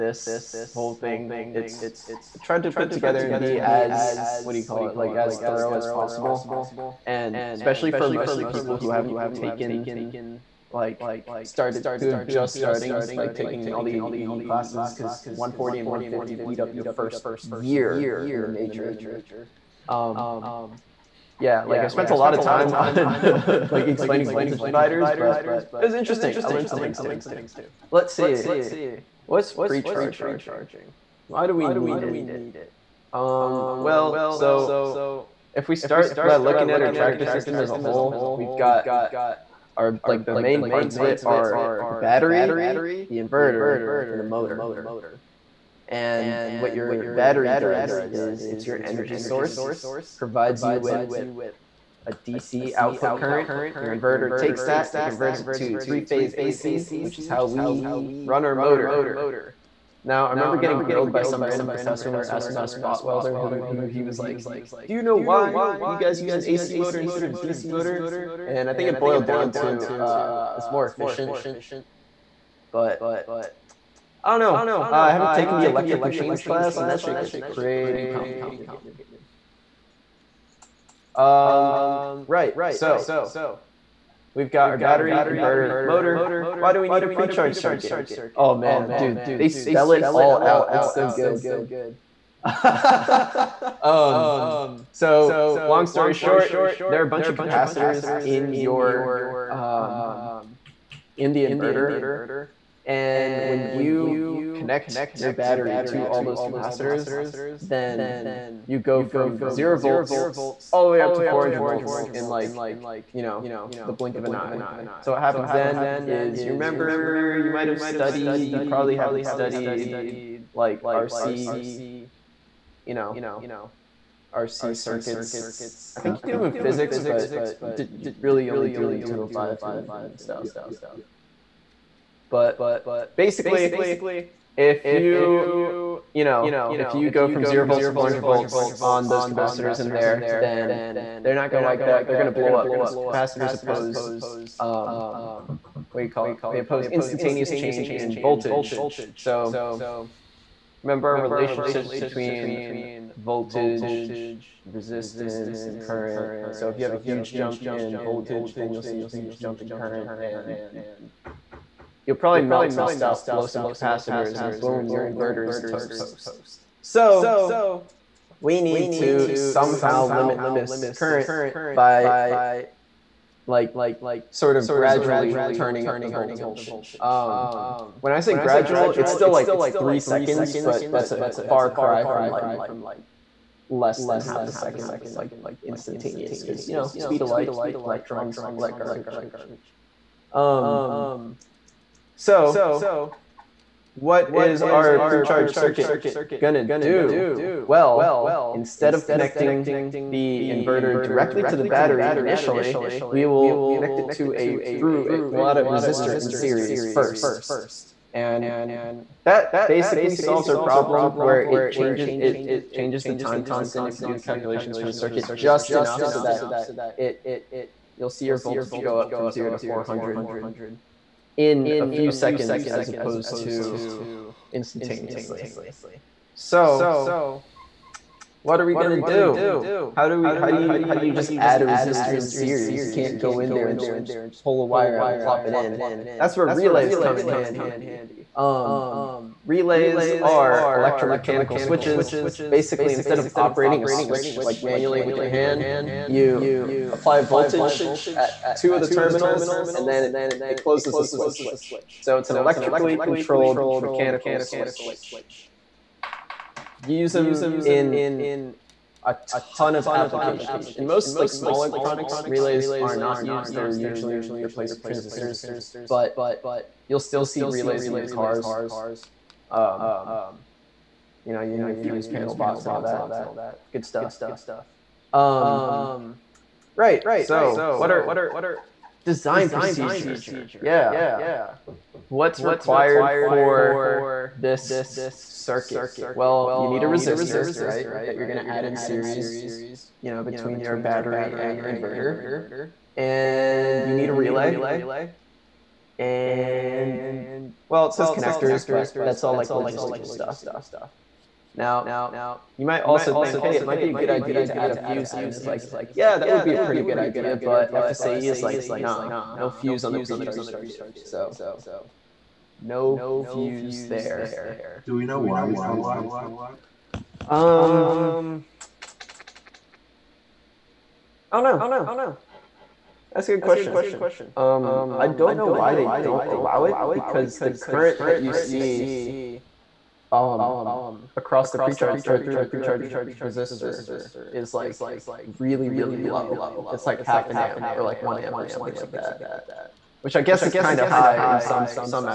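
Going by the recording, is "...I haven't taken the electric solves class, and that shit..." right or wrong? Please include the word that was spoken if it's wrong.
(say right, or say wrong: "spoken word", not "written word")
wrong: "machines", not "solves".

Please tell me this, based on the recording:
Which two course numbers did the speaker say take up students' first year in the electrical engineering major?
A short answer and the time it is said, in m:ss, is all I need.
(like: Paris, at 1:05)
140 and 150, at 0:15.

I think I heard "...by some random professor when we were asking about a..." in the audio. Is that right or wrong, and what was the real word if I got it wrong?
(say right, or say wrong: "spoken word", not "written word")
right.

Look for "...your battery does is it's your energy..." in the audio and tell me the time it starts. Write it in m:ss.
0:46.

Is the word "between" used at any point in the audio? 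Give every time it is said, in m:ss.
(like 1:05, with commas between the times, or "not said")
2:31, 4:50.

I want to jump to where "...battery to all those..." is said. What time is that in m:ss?
1:45.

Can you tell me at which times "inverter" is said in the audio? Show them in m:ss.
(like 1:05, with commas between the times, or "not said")
0:43, 0:53, 1:25, 1:41, 2:45, 3:20, 4:51.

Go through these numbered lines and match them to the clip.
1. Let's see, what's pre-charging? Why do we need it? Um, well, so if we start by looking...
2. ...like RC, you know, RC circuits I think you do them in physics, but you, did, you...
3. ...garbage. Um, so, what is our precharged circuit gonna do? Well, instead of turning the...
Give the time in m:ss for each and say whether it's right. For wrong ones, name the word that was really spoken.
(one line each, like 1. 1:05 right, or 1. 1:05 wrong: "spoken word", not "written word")
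1. 0:27 right
2. 2:00 right
3. 3:08 wrong: "connecting", not "turning".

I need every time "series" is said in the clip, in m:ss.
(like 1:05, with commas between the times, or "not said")
3:26, 3:52, 4:48.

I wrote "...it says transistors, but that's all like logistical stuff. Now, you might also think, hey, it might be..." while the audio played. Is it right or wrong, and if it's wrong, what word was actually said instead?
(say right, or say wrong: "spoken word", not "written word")
wrong: "connectors", not "transistors".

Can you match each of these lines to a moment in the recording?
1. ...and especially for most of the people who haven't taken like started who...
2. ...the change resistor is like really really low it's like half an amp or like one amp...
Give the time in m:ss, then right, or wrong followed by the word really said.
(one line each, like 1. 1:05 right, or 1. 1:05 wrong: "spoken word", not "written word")
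1. 0:07 right
2. 5:32 wrong: "precharge", not "change".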